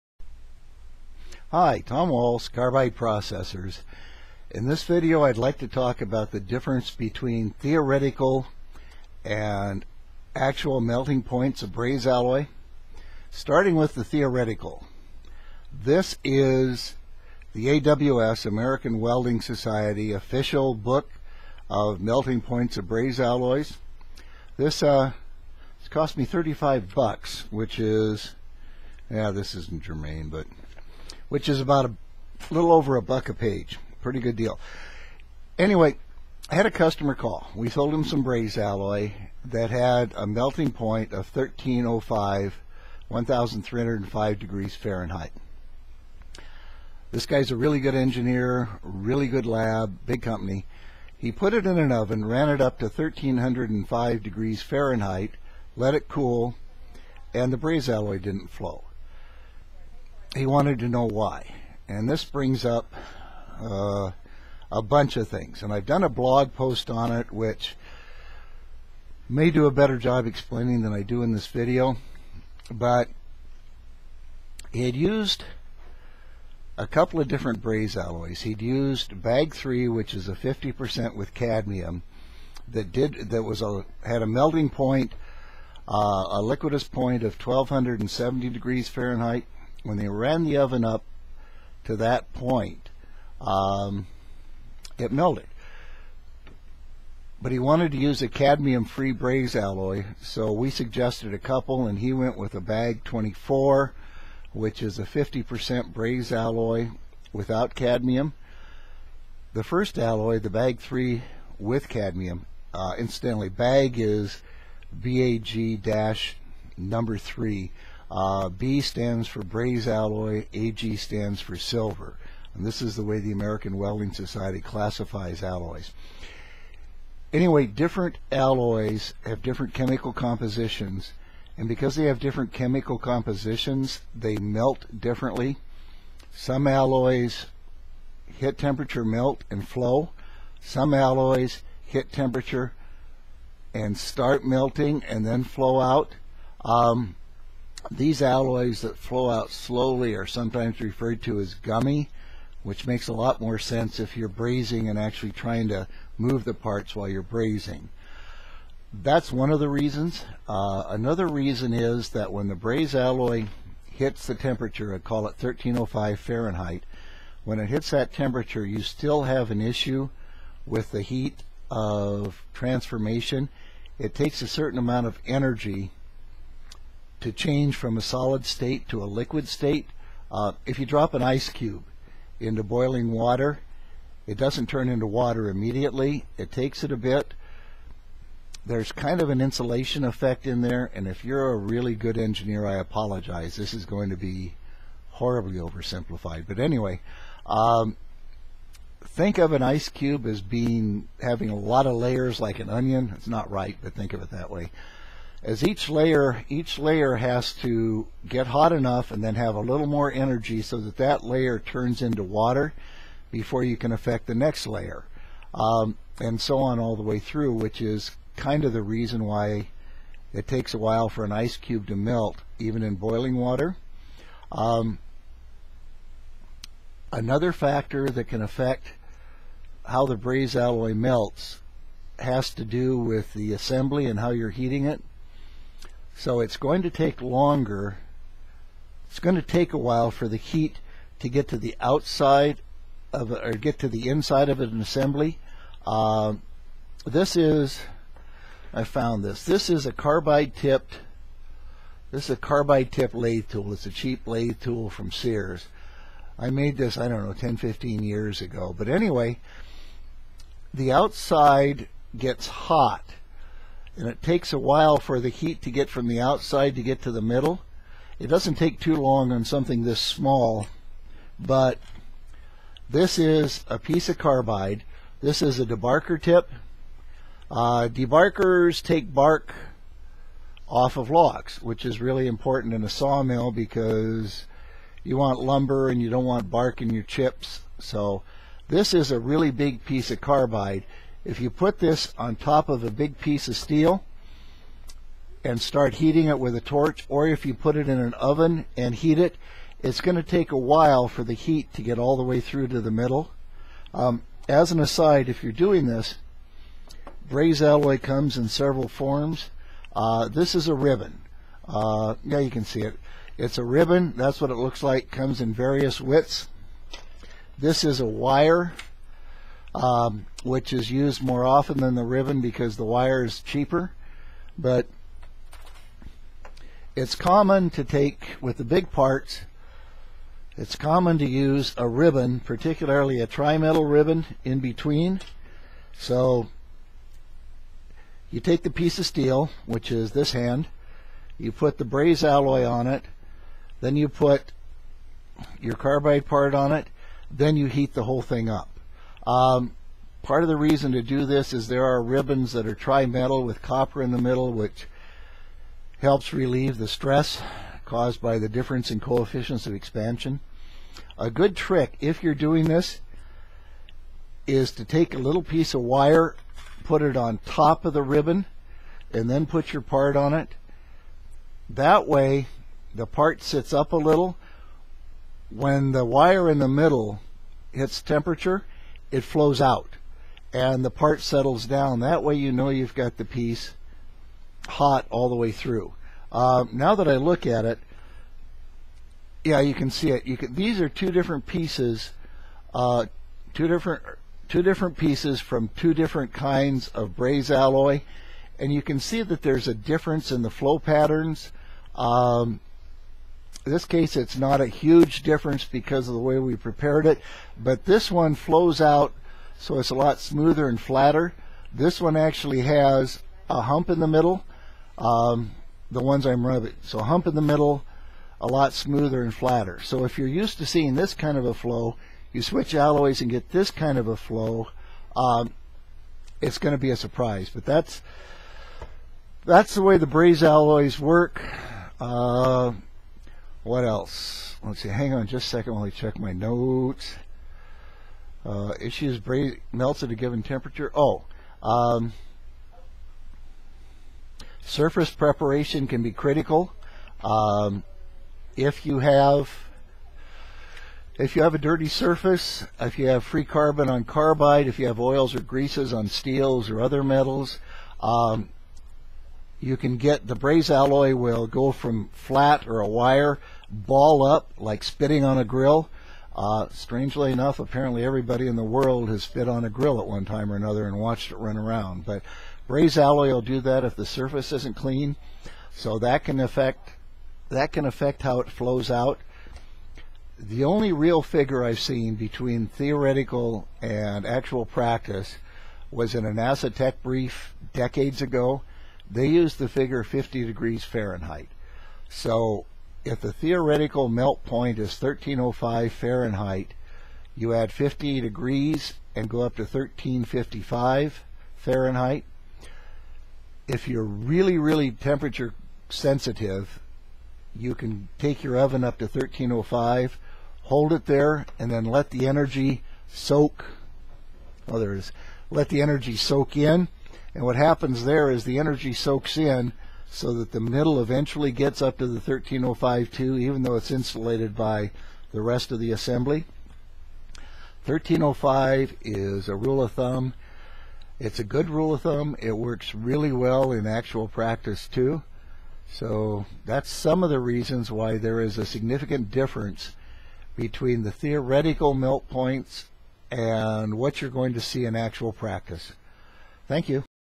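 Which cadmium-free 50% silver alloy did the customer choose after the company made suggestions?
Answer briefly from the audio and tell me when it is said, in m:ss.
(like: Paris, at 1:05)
BAg 24, at 1:42.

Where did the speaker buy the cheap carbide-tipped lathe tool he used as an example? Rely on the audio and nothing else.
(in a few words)
Sears.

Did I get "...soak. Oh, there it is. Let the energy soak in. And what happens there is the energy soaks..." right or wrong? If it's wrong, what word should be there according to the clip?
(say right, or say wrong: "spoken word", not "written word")
right.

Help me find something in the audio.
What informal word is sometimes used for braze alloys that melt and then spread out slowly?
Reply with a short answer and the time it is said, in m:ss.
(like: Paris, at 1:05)
gummy, at 2:31.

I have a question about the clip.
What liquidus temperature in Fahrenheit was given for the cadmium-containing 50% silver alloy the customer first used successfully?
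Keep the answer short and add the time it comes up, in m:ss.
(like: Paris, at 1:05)
1270 degrees Fahrenheit, at 1:27.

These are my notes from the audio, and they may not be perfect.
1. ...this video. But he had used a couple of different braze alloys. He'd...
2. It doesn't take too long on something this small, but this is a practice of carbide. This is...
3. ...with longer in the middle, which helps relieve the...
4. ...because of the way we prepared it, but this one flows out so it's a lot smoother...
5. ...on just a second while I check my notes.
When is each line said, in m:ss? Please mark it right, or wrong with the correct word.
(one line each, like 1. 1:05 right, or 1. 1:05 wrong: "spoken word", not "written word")
1. 1:11 right
2. 4:28 wrong: "piece", not "practice"
3. 5:53 wrong: "copper", not "longer"
4. 6:45 right
5. 7:15 right.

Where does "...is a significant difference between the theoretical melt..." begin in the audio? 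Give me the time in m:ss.
8:58.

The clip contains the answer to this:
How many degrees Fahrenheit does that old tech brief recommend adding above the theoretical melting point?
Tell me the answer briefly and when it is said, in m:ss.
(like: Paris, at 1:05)
50 degrees Fahrenheit, at 8:10.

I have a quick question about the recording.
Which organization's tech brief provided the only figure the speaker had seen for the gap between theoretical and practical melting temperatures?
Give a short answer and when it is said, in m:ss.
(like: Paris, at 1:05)
NASA, at 8:06.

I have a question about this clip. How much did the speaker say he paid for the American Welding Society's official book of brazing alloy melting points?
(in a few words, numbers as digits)
35 bucks.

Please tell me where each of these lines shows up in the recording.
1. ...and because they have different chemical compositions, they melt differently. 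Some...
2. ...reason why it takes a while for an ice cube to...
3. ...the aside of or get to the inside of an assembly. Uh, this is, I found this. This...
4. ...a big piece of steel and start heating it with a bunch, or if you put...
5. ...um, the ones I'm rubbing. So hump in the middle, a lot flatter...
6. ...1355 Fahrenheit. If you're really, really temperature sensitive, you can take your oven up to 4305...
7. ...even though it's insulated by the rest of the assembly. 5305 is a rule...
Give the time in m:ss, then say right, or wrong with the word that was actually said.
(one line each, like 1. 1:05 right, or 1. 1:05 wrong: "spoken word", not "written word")
1. 2:11 right
2. 3:38 right
3. 4:01 wrong: "outside", not "aside"
4. 4:52 wrong: "torch", not "bunch"
5. 6:54 wrong: "smoother", not "flatter"
6. 8:19 wrong: "1305", not "4305"
7. 8:43 wrong: "1305", not "5305".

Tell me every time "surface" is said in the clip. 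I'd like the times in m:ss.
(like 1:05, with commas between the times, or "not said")
7:24, 7:31, 7:54.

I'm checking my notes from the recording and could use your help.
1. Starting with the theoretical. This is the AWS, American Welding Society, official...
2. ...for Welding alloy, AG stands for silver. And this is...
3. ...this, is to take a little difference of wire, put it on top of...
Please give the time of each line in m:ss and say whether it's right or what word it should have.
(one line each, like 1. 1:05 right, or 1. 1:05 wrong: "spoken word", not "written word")
1. 0:13 right
2. 1:59 wrong: "Braze", not "Welding"
3. 6:02 wrong: "piece", not "difference".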